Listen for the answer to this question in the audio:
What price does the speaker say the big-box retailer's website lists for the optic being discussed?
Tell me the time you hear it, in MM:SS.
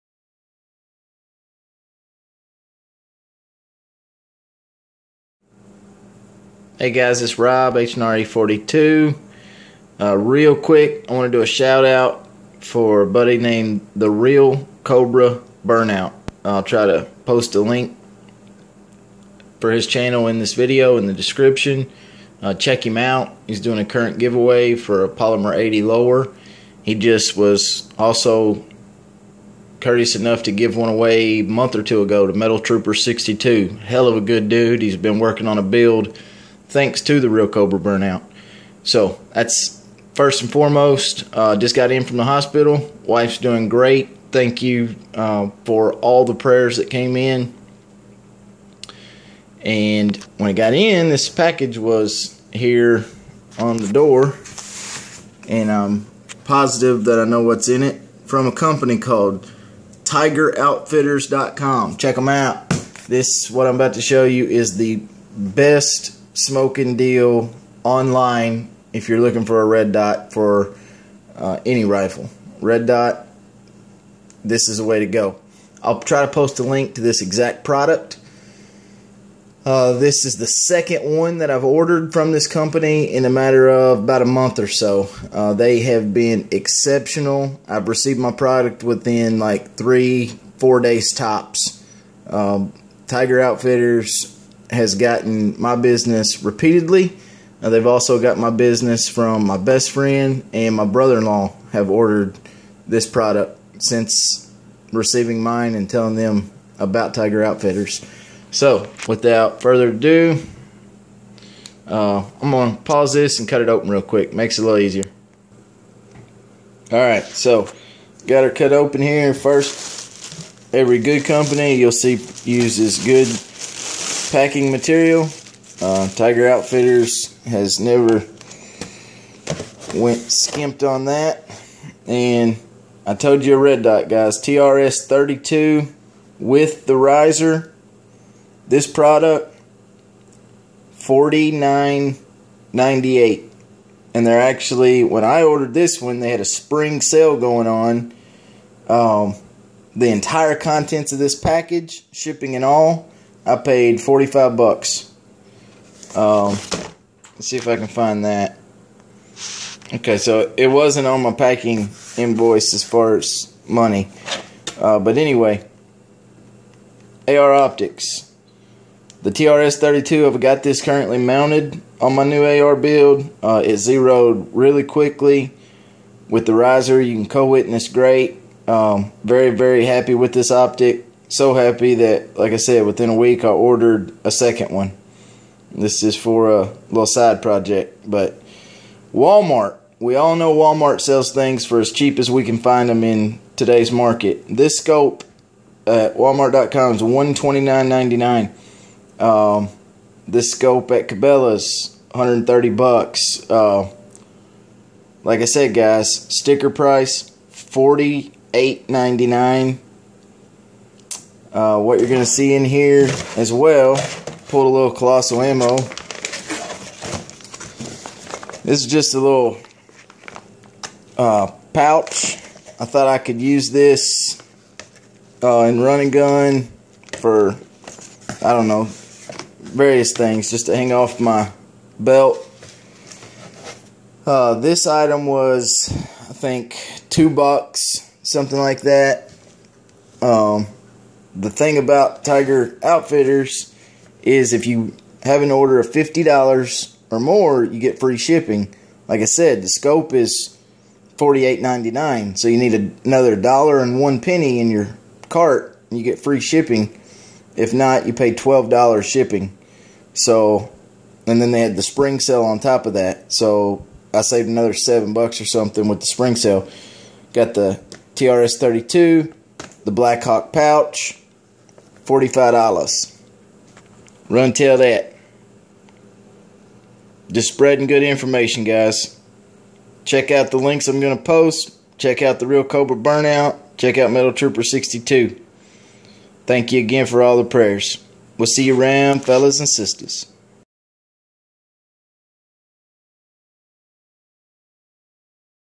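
03:17.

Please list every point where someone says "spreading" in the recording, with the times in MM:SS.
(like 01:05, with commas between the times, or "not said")
04:37.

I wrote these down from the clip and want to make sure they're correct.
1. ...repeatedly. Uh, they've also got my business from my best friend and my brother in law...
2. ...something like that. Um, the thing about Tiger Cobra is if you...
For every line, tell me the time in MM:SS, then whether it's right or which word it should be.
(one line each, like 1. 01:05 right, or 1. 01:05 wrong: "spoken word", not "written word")
1. 01:36 right
2. 03:58 wrong: "Outfitters", not "Cobra".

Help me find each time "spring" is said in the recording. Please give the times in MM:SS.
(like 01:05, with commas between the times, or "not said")
02:26, 04:21, 04:26.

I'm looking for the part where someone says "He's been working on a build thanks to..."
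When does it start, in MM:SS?
00:34.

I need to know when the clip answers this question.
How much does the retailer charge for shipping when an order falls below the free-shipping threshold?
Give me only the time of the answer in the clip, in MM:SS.
04:18.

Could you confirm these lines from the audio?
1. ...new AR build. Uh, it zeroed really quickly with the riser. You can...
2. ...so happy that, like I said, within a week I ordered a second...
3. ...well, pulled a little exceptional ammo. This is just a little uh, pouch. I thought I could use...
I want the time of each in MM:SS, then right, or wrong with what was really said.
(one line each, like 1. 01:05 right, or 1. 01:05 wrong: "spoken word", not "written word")
1. 02:52 right
2. 03:01 right
3. 03:33 wrong: "colossal", not "exceptional".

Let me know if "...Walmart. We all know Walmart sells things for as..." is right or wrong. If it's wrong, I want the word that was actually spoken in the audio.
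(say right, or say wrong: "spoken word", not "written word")
right.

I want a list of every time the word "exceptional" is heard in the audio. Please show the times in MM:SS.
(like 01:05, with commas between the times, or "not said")
01:26.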